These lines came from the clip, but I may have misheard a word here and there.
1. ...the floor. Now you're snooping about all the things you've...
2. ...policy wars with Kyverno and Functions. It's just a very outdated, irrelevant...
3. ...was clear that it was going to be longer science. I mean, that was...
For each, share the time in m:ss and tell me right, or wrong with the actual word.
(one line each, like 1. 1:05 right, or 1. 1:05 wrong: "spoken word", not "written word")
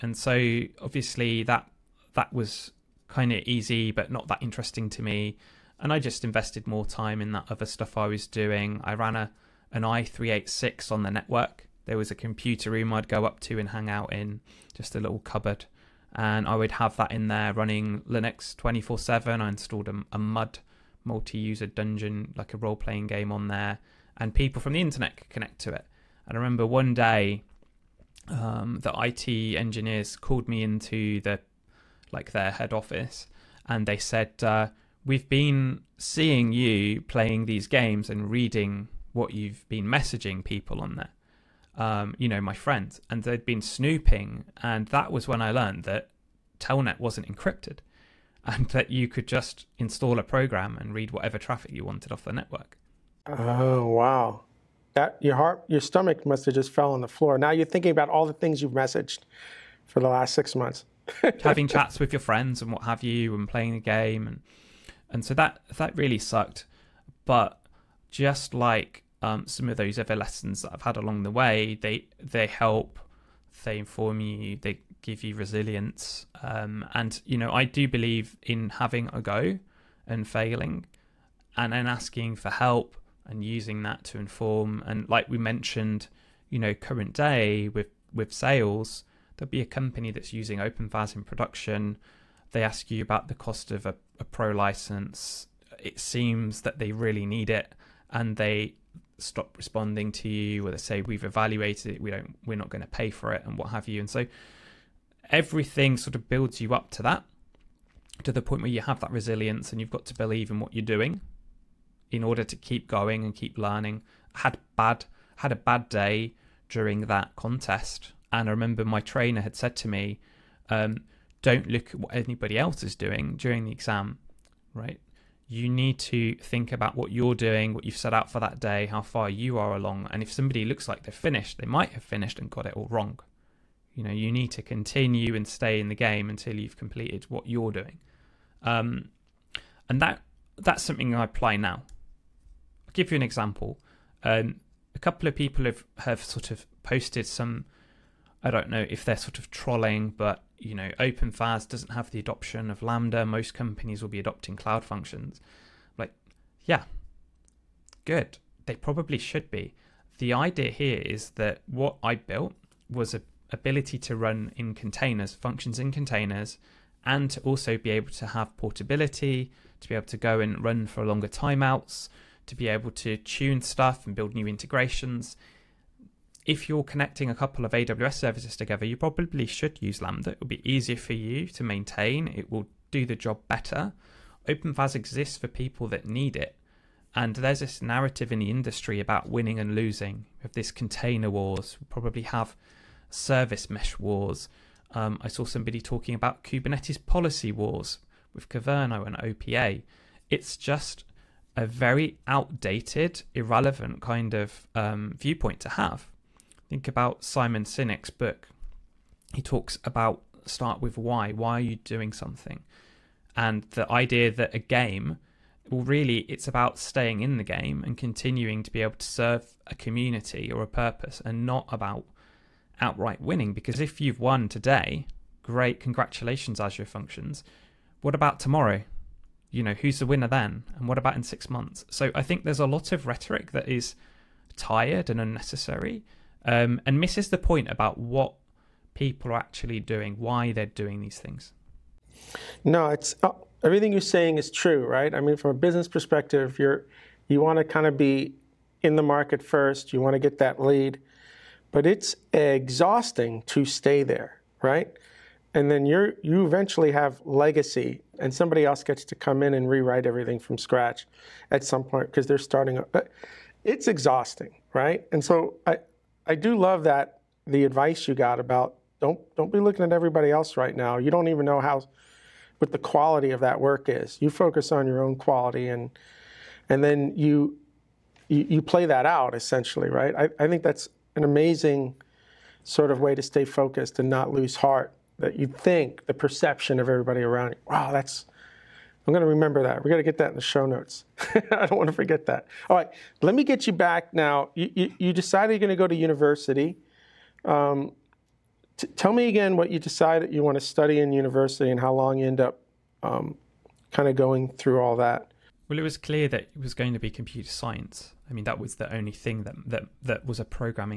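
1. 0:57 wrong: "thinking", not "snooping"
2. 3:17 wrong: "OPA", not "Functions"
3. 5:05 wrong: "computer", not "longer".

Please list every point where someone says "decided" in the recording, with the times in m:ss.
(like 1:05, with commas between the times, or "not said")
4:55, 4:59.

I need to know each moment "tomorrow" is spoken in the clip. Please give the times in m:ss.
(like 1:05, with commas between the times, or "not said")
3:48.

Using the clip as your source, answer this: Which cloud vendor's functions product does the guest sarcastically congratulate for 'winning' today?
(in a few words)
Azure Functions.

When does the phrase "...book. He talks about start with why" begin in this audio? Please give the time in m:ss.
3:28.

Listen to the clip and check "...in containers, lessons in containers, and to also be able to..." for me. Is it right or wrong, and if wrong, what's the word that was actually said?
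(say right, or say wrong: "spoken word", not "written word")
wrong: "functions", not "lessons".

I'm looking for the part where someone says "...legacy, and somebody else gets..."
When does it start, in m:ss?
4:17.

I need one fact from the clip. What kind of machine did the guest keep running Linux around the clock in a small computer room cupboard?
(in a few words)
i386.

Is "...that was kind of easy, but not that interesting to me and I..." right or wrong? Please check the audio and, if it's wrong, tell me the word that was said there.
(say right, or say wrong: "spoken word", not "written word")
right.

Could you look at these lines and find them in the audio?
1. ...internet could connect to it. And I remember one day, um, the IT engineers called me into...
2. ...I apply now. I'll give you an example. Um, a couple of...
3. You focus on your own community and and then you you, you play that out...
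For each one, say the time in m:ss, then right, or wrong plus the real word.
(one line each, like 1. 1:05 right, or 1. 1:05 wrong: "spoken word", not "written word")
1. 0:24 right
2. 2:21 right
3. 4:34 wrong: "quality", not "community".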